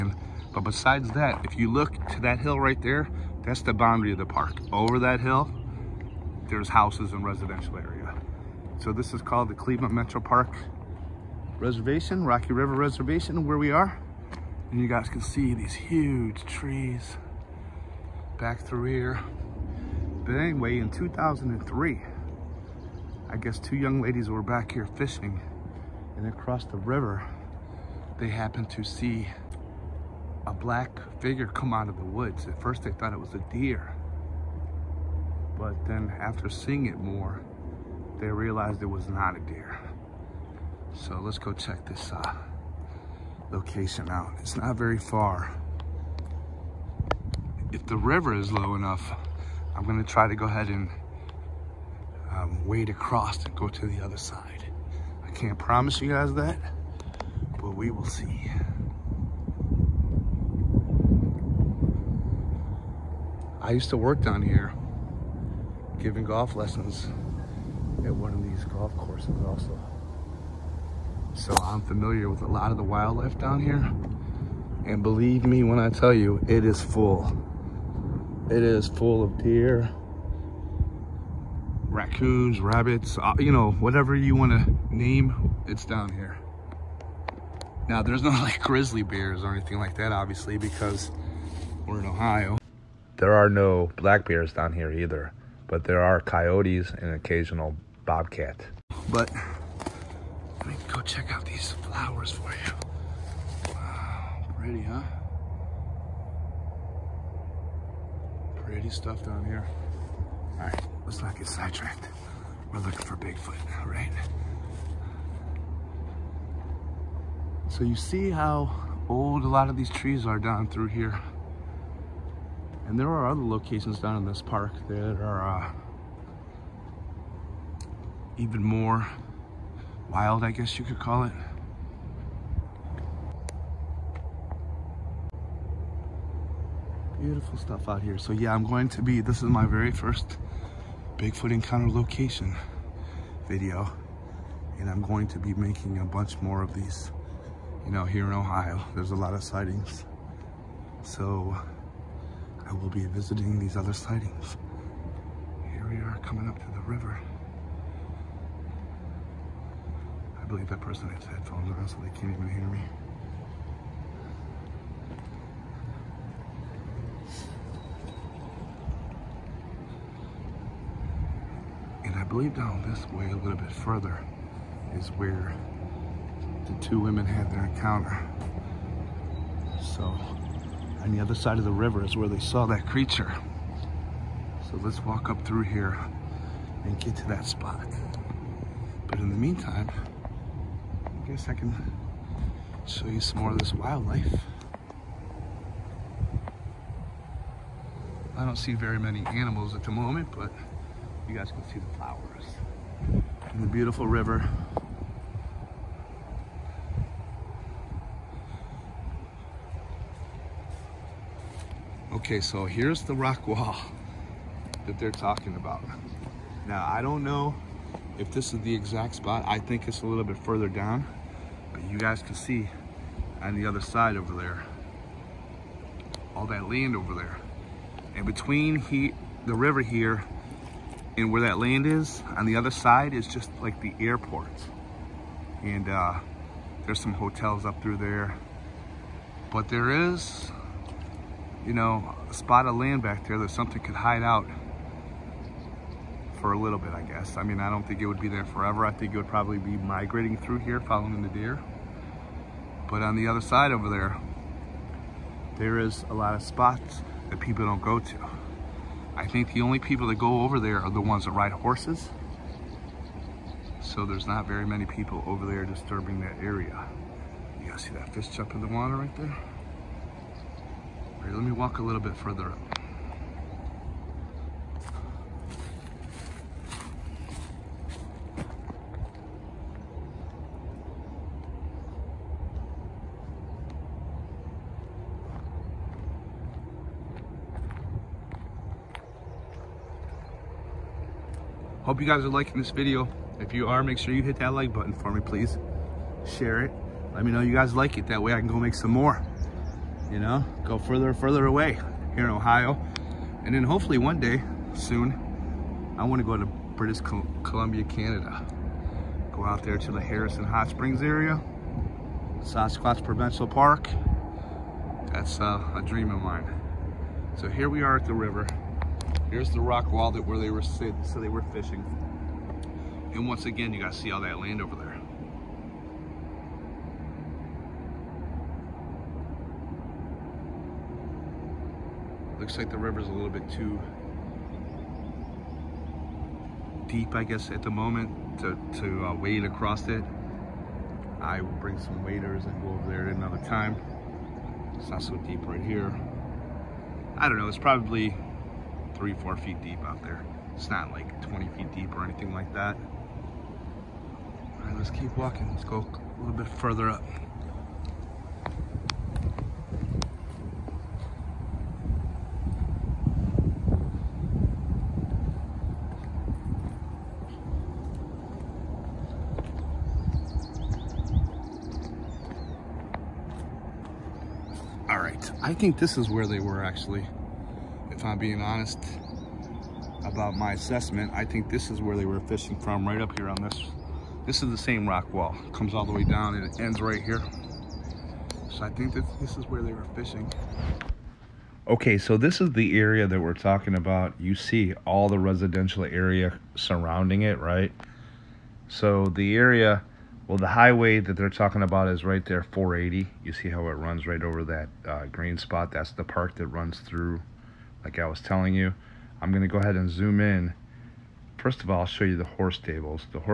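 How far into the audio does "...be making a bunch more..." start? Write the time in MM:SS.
02:25.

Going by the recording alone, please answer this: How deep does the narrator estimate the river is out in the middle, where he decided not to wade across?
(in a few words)
3 to 4 feet.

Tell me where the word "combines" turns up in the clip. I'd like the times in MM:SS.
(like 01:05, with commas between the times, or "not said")
not said.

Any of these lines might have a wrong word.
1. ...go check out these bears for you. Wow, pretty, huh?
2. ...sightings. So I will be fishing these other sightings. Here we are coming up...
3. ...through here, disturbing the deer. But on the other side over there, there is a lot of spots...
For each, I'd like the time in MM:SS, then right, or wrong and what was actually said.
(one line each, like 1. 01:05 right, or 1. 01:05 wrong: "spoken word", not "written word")
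1. 01:40 wrong: "flowers", not "bears"
2. 02:29 wrong: "visiting", not "fishing"
3. 04:10 wrong: "following", not "disturbing".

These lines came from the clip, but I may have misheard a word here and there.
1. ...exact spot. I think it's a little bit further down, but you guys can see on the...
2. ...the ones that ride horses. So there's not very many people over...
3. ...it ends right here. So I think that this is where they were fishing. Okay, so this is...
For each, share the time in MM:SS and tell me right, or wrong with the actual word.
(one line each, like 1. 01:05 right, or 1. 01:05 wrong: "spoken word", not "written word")
1. 03:38 right
2. 04:20 right
3. 06:26 right.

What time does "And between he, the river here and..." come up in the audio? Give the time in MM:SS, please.
03:48.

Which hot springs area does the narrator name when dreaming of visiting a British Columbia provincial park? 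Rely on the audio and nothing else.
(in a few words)
Harrison Hot Springs.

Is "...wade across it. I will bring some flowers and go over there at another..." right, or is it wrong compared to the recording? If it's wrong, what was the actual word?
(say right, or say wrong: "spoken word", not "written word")
wrong: "waders", not "flowers".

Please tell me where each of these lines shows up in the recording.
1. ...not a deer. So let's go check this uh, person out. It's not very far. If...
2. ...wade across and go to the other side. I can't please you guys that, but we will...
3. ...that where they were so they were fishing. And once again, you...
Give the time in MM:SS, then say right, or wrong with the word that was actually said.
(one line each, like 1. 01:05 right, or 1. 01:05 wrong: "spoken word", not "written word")
1. 00:39 wrong: "location", not "person"
2. 00:52 wrong: "promise", not "please"
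3. 05:20 right.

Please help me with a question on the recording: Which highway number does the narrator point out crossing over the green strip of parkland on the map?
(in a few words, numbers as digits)
480.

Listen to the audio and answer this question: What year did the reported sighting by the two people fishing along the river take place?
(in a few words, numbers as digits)
2003.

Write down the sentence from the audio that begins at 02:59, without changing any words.
So on the other side of the river is where they saw that creature.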